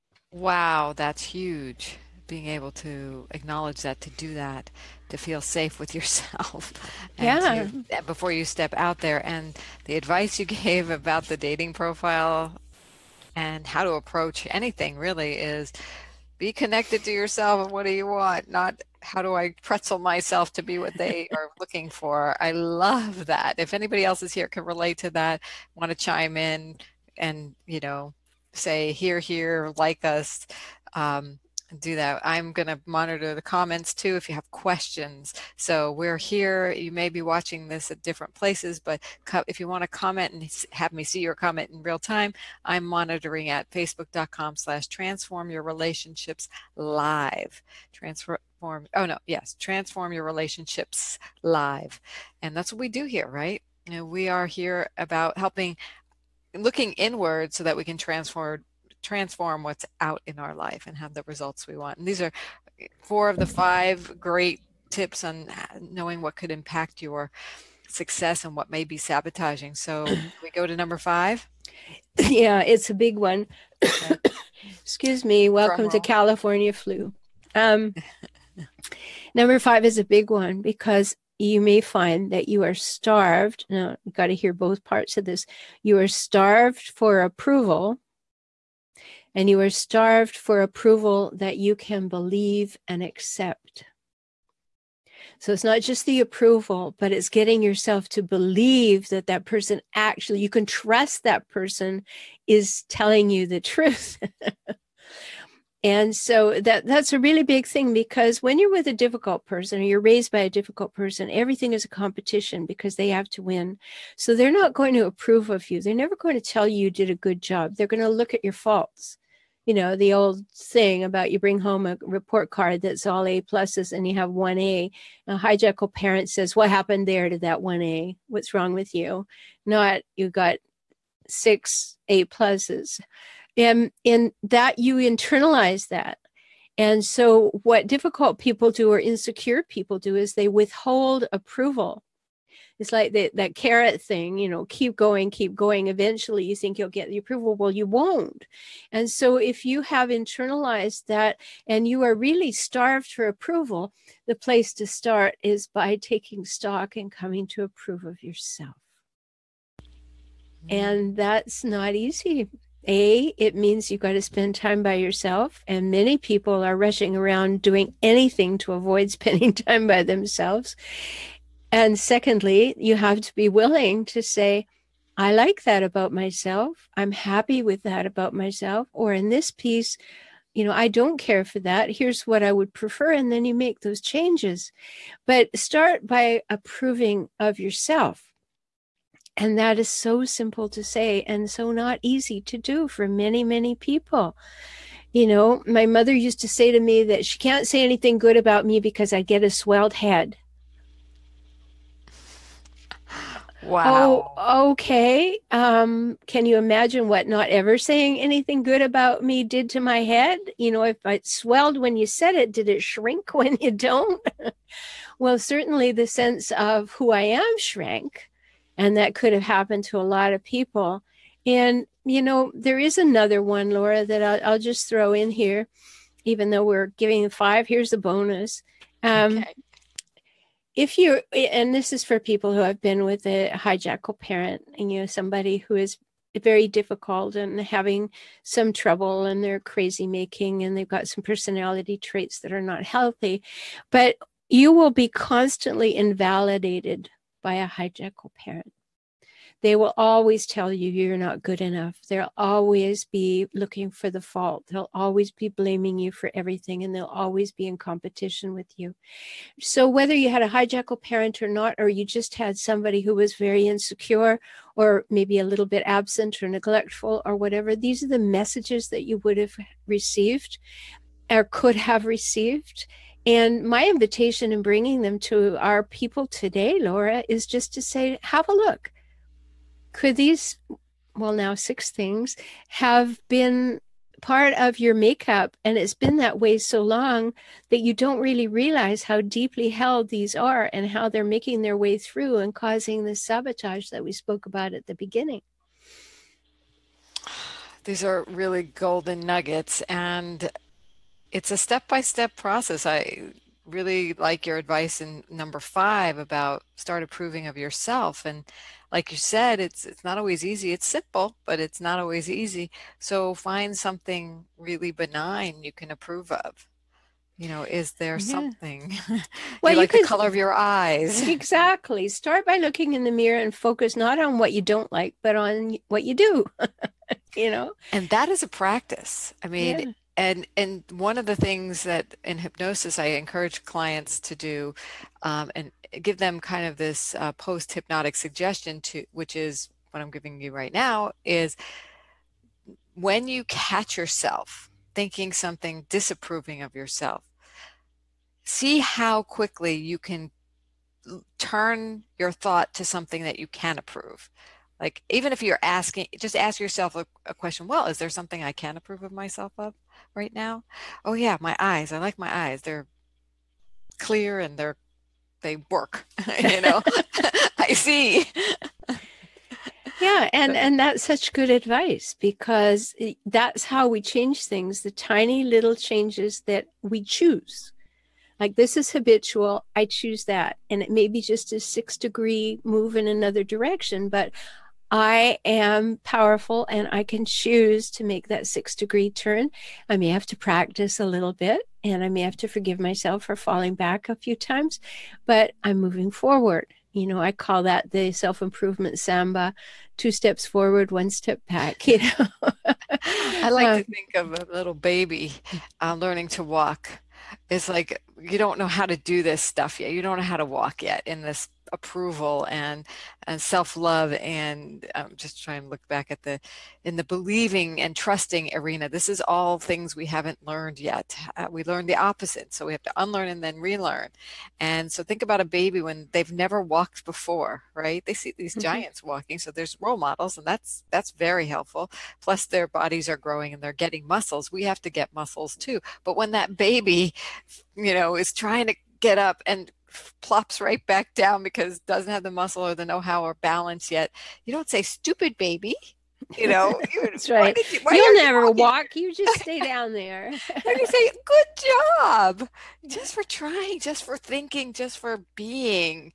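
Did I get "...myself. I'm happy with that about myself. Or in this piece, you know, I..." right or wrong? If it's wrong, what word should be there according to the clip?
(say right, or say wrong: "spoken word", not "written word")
right.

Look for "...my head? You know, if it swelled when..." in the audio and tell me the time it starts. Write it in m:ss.
3:29.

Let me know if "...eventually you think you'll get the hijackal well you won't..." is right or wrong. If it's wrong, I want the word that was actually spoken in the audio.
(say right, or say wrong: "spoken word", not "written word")
wrong: "approval", not "hijackal".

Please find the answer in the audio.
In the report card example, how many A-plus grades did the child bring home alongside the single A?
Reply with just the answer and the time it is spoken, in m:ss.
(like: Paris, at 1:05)
6, at 2:11.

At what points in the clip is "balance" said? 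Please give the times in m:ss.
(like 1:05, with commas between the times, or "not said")
7:23.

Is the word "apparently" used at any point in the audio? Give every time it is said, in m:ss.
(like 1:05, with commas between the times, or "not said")
not said.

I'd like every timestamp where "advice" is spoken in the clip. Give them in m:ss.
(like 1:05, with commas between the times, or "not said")
0:09, 5:04, 6:11.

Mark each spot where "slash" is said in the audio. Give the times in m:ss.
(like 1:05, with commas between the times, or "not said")
0:44.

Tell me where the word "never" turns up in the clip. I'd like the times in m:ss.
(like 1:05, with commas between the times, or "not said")
1:55, 7:06, 7:28.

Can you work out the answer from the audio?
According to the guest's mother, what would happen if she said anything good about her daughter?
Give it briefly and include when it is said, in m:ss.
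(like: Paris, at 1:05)
a swelled head, at 3:19.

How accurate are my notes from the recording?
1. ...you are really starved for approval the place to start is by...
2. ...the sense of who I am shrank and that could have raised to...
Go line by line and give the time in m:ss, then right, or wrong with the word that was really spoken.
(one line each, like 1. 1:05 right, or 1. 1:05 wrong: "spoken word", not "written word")
1. 2:31 right
2. 3:35 wrong: "happened", not "raised".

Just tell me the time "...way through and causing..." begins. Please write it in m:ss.
4:51.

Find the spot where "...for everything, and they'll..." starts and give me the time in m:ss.
4:16.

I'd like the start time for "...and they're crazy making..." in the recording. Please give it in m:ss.
3:59.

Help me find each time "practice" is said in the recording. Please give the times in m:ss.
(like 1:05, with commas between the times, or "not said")
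5:28, 6:30.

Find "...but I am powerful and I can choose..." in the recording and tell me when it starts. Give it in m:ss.
6:24.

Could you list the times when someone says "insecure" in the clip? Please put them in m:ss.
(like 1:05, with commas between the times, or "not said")
2:19, 4:23.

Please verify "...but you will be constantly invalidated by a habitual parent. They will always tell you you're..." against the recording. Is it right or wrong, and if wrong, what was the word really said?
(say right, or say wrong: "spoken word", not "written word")
wrong: "hijackal", not "habitual".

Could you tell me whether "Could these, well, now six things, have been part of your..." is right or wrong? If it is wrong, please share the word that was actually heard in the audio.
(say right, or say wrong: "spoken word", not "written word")
right.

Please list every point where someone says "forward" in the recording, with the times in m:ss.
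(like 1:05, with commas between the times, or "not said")
6:36, 6:40.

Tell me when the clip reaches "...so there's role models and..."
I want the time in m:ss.
7:09.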